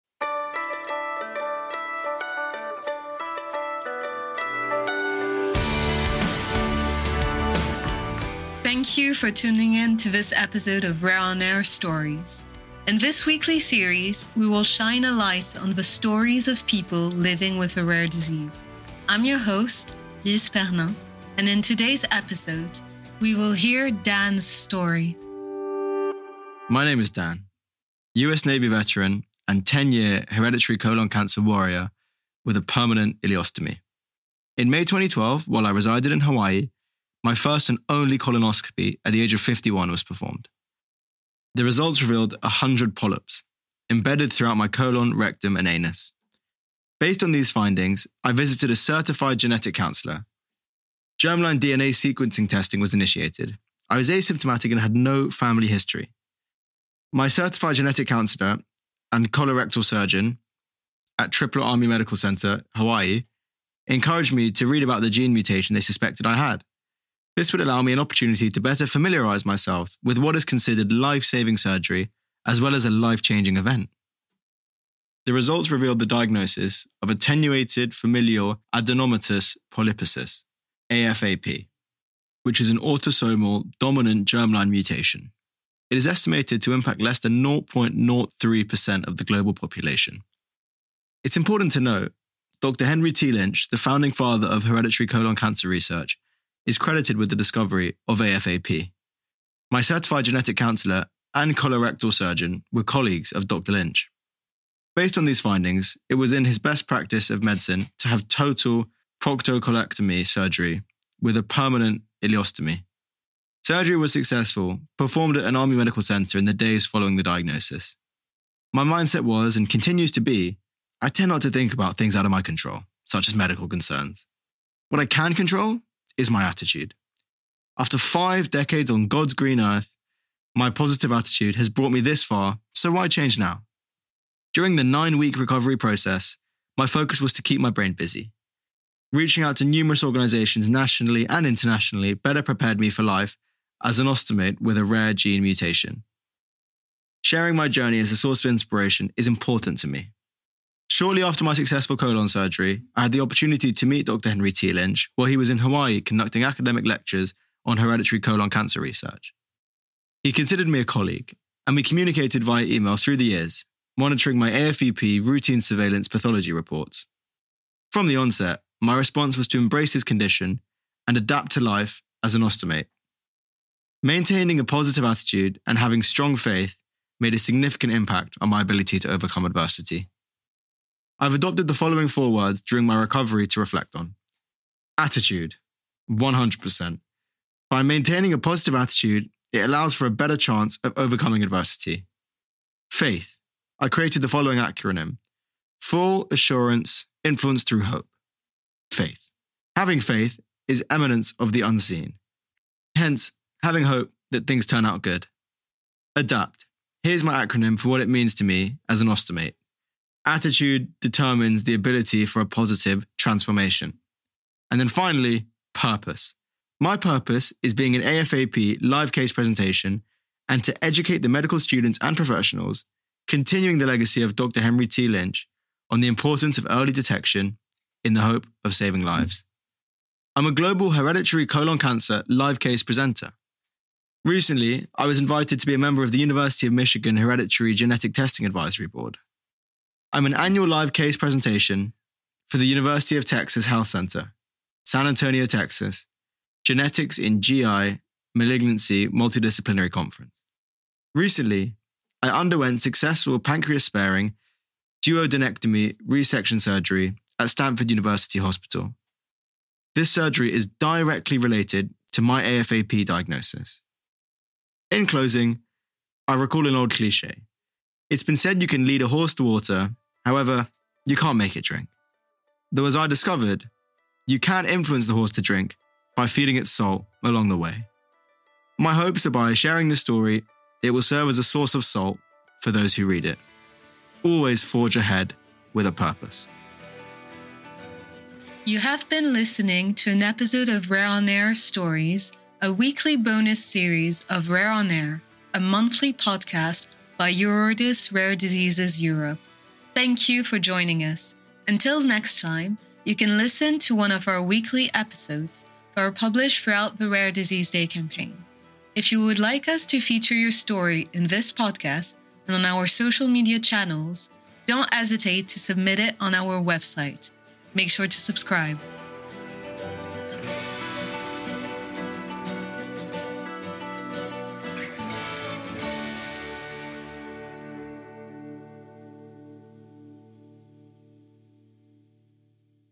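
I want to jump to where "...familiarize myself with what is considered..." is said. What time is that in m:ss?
1:08.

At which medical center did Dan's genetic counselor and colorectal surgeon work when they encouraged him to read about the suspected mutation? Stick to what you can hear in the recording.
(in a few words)
Tripler Army Medical Center.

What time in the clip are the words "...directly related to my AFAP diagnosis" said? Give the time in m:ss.
4:20.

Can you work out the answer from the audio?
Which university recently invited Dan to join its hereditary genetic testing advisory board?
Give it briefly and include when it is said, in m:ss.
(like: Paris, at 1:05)
University of Michigan, at 3:56.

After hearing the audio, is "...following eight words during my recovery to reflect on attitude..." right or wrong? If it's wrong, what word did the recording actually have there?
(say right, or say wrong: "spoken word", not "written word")
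wrong: "four", not "eight".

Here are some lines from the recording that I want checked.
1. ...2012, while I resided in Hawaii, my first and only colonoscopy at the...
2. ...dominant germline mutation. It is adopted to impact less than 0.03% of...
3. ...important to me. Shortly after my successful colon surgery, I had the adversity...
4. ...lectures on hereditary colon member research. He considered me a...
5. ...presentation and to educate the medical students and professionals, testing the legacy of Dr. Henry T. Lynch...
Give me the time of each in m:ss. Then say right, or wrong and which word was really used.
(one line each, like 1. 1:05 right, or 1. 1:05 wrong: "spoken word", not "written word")
1. 0:34 right
2. 1:23 wrong: "estimated", not "adopted"
3. 2:29 wrong: "opportunity", not "adversity"
4. 2:36 wrong: "cancer", not "member"
5. 3:39 wrong: "continuing", not "testing".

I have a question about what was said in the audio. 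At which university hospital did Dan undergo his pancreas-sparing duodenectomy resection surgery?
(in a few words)
Stanford University Hospital.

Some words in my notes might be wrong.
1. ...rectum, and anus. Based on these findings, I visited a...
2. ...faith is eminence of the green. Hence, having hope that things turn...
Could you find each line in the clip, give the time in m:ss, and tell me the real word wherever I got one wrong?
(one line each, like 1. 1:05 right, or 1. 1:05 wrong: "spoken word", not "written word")
1. 0:45 right
2. 3:20 wrong: "unseen", not "green".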